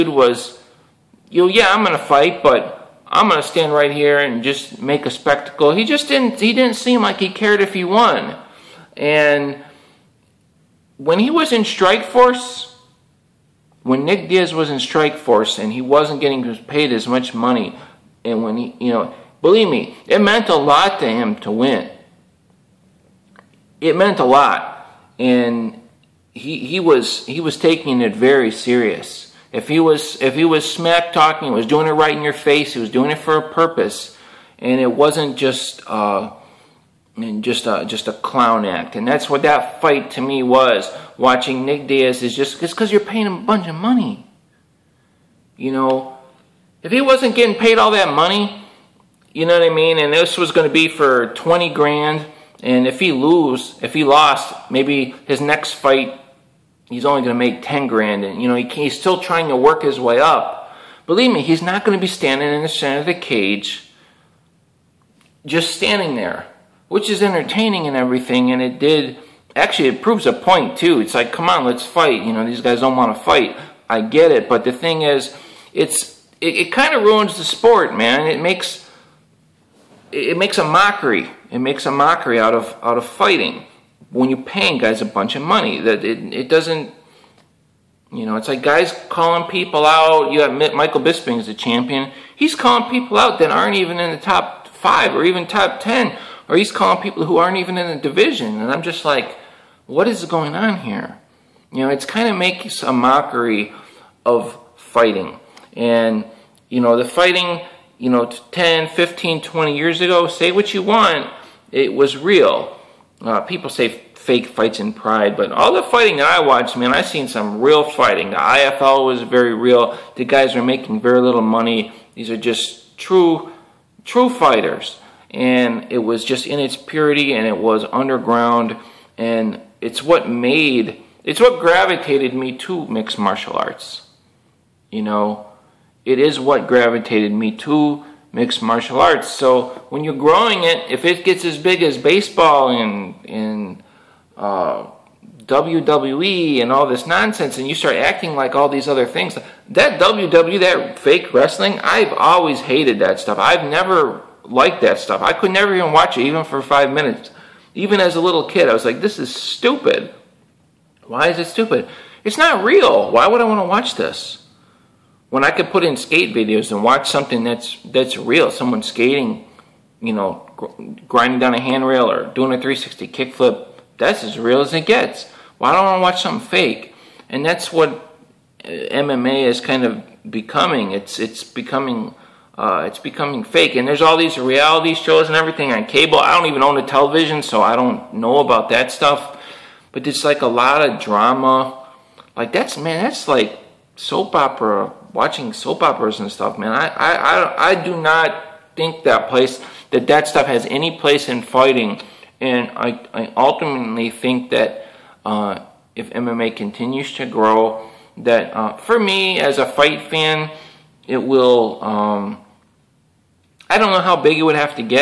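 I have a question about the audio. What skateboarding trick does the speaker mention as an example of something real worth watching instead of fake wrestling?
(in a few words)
360 kickflip.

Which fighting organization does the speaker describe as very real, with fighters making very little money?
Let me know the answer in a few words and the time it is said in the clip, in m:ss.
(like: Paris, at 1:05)
IFL, at 1:58.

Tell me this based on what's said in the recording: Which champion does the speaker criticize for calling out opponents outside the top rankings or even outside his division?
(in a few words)
Michael Bisping.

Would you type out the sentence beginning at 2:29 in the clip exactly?
That WWE, that fake wrestling, I've always hated that stuff.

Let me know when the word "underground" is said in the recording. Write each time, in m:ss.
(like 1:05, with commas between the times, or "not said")
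2:07.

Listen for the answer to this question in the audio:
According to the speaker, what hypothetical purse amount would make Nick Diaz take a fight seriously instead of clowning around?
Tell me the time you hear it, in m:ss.
0:51.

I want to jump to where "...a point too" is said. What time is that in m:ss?
1:10.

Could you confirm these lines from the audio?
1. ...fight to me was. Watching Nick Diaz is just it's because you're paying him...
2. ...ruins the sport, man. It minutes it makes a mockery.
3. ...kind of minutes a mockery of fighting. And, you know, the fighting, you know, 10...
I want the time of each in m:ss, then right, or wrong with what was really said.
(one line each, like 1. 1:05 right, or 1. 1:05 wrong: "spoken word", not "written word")
1. 0:39 right
2. 1:17 wrong: "makes", not "minutes"
3. 1:42 wrong: "makes", not "minutes".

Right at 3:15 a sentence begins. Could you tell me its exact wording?
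Watching soap operas and stuff, man.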